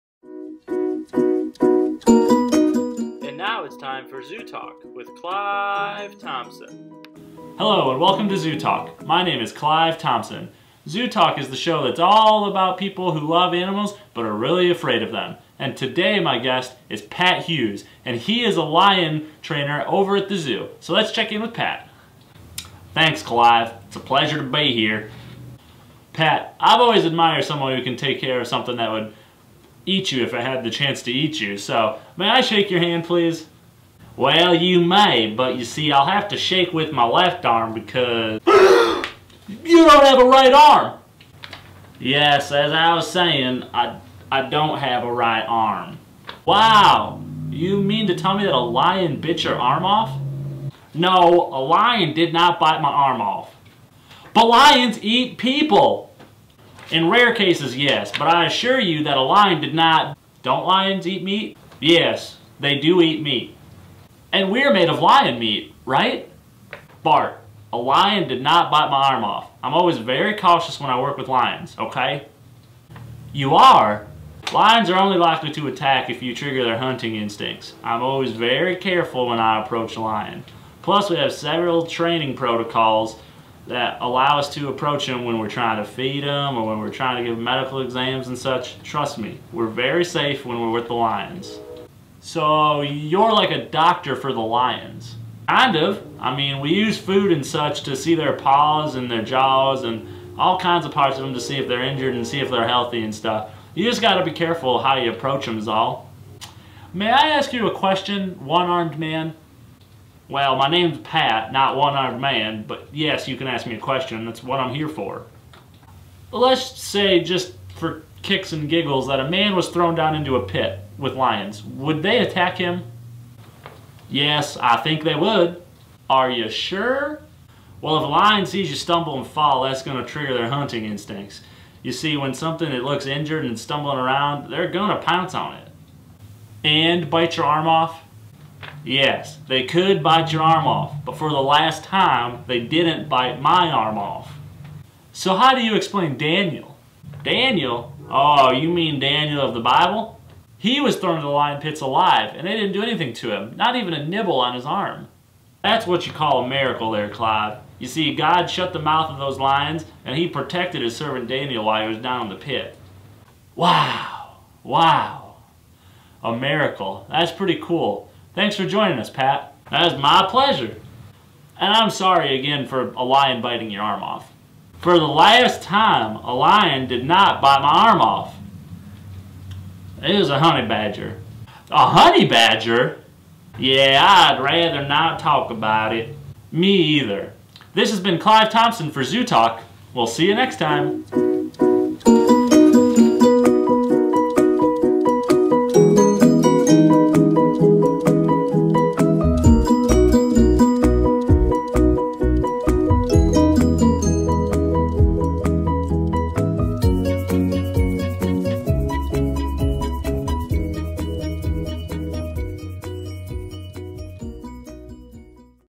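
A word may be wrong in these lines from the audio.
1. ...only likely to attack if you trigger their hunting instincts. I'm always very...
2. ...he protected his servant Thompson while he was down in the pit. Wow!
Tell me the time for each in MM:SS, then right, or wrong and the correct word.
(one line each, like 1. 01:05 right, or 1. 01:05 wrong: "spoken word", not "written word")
1. 01:14 right
2. 02:40 wrong: "Daniel", not "Thompson".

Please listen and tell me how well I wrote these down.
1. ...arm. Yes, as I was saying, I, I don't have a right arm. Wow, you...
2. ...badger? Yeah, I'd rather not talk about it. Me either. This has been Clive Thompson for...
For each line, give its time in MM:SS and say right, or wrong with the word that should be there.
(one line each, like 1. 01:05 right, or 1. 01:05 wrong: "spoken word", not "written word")
1. 00:40 right
2. 03:02 right.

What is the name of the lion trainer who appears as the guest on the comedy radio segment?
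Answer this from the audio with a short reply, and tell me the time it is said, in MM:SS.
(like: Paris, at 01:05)
Pat Hughes, at 00:17.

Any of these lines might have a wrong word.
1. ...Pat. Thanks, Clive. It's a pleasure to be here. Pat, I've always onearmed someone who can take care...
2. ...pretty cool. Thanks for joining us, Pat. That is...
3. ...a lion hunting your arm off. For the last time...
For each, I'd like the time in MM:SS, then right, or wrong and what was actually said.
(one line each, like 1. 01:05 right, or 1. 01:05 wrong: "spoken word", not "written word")
1. 00:21 wrong: "admired", not "onearmed"
2. 02:47 right
3. 02:52 wrong: "biting", not "hunting".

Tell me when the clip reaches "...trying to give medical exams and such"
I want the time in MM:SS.
01:26.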